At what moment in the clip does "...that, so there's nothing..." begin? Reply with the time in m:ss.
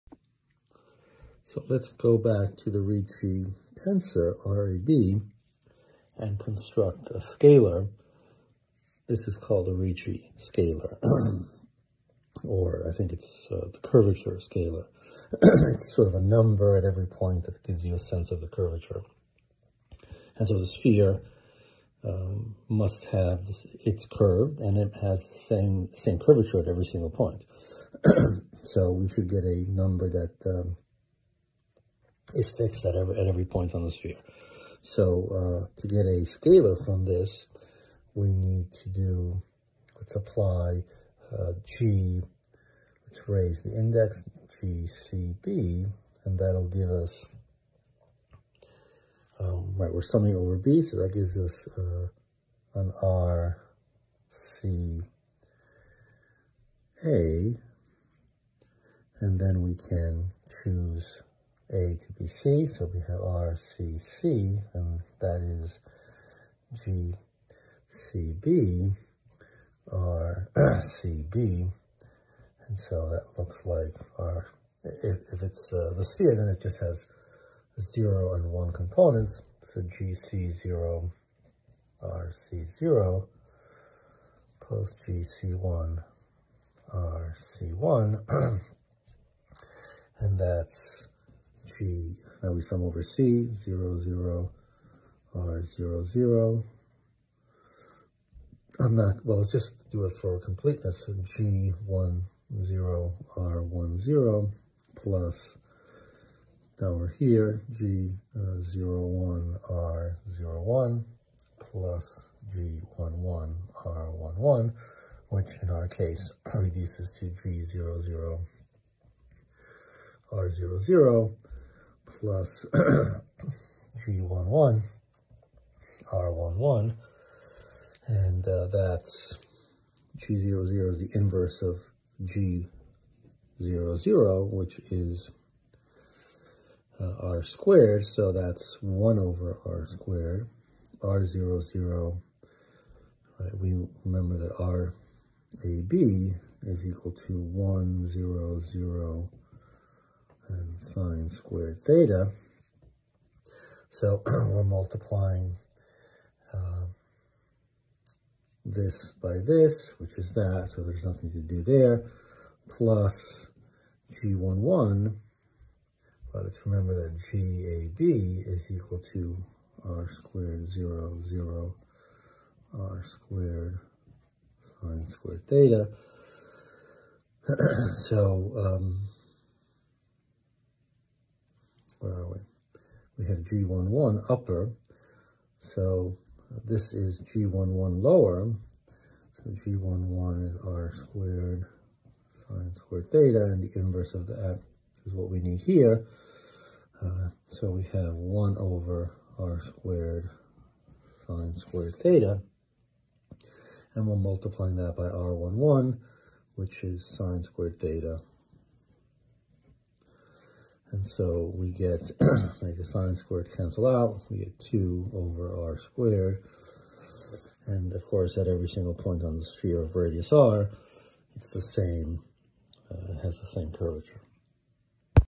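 2:40.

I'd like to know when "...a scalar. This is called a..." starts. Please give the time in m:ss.
0:07.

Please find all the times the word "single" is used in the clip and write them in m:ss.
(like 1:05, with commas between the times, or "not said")
0:26, 3:38.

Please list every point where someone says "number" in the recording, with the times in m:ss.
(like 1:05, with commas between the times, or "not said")
0:16, 0:29.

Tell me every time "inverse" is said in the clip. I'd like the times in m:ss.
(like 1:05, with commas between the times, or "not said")
2:11, 3:13.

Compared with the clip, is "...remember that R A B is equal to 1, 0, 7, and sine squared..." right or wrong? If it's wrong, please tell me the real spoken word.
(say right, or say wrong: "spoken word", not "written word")
wrong: "0", not "7".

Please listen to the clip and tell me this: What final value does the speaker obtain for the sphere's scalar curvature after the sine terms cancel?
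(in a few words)
2 over r squared.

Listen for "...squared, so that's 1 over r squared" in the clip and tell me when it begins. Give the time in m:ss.
2:17.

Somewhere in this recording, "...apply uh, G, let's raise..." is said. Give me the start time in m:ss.
0:40.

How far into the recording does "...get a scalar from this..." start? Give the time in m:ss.
0:35.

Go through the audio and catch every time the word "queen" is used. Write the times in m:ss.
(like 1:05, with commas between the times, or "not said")
not said.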